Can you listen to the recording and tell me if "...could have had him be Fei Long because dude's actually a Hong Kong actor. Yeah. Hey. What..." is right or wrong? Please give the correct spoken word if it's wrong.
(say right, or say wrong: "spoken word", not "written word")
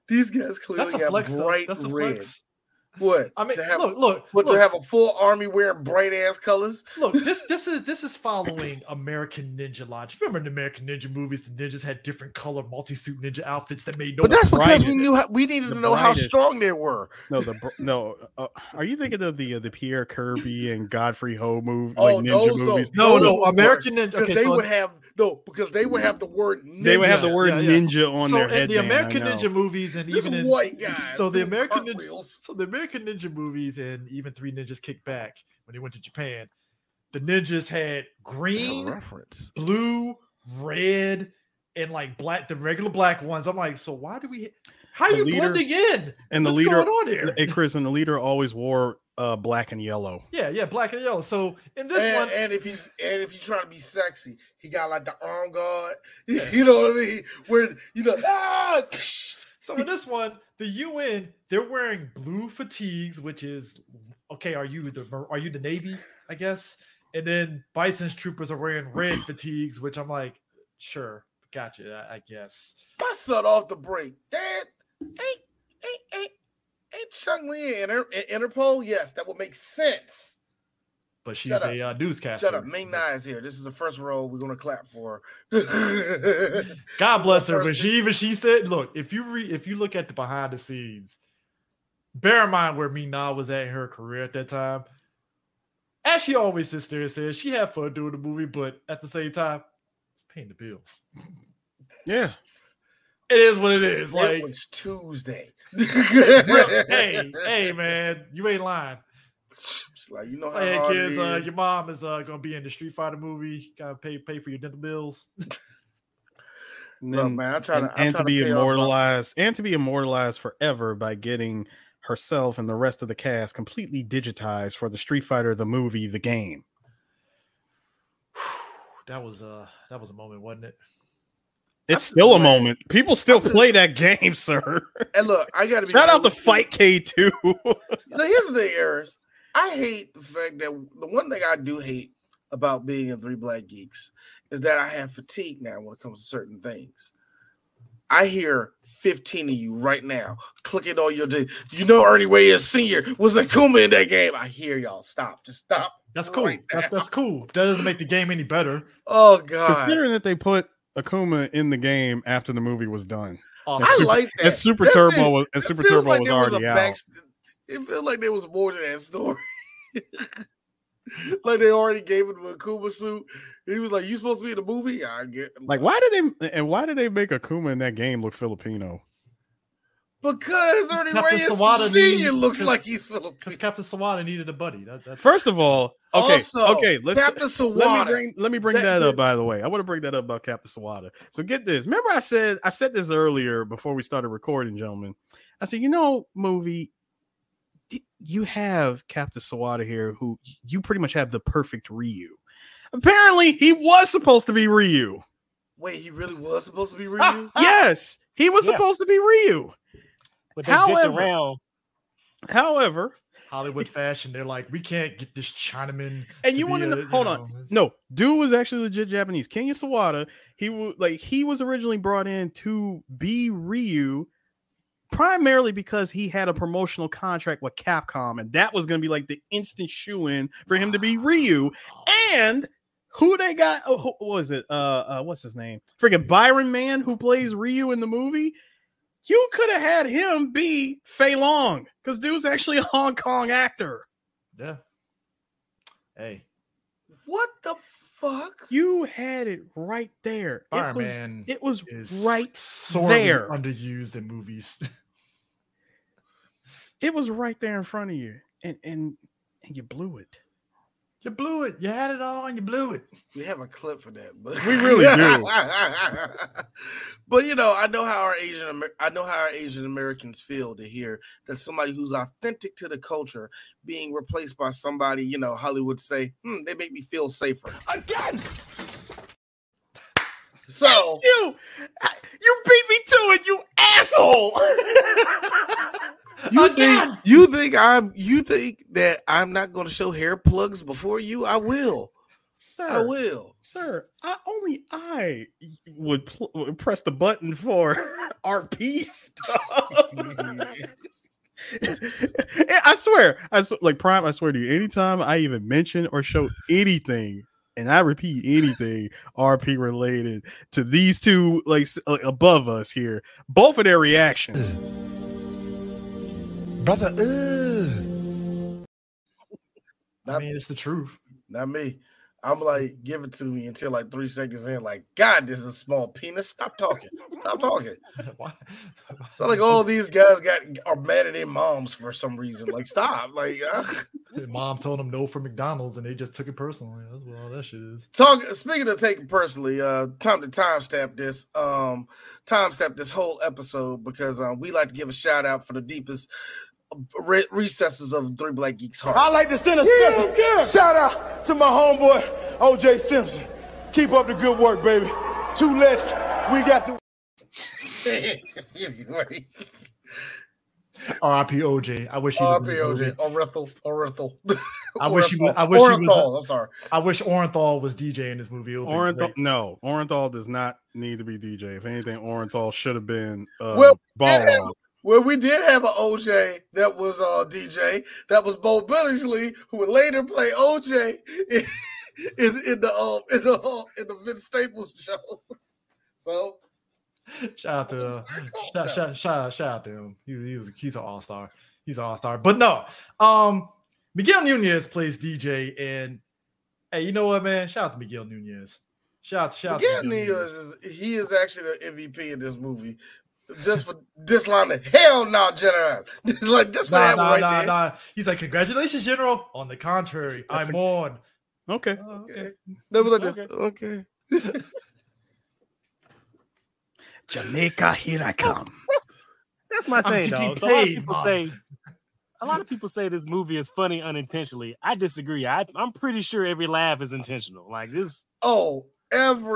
right.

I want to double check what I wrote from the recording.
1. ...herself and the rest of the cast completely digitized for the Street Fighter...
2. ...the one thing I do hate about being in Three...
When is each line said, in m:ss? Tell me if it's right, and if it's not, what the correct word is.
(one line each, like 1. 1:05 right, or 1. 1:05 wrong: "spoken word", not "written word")
1. 2:01 right
2. 2:20 right.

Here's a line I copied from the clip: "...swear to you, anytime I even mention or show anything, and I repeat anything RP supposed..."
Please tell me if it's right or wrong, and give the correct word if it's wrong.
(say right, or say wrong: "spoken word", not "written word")
wrong: "related", not "supposed".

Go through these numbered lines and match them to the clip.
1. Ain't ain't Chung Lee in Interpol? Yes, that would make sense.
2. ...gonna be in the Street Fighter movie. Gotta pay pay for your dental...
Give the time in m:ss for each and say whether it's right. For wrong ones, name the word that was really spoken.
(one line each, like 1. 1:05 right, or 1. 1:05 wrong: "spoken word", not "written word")
1. 1:15 right
2. 1:52 right.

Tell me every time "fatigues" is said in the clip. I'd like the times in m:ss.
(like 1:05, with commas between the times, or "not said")
1:02, 1:09, 2:25.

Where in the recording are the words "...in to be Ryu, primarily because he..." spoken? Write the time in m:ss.
3:42.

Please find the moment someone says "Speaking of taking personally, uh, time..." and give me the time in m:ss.
5:38.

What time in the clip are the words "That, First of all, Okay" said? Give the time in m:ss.
3:04.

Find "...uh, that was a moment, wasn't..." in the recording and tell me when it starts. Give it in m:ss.
2:09.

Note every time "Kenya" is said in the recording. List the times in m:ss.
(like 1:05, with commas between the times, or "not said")
3:39.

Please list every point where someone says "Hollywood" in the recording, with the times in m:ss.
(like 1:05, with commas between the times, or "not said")
3:33, 4:35.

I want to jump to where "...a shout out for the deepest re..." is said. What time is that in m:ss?
5:45.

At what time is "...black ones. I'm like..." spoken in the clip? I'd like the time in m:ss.
0:42.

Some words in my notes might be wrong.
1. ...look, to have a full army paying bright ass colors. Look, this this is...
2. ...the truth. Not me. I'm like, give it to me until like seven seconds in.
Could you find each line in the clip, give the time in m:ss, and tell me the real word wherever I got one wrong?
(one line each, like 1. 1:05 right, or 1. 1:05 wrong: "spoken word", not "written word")
1. 0:04 wrong: "wearing", not "paying"
2. 5:20 wrong: "three", not "seven".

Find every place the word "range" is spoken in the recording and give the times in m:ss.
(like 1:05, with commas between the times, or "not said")
not said.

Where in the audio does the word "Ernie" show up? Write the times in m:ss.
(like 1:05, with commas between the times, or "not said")
2:32, 3:00.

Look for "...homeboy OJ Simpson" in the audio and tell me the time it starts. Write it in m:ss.
5:51.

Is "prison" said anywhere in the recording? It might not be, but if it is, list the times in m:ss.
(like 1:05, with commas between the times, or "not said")
not said.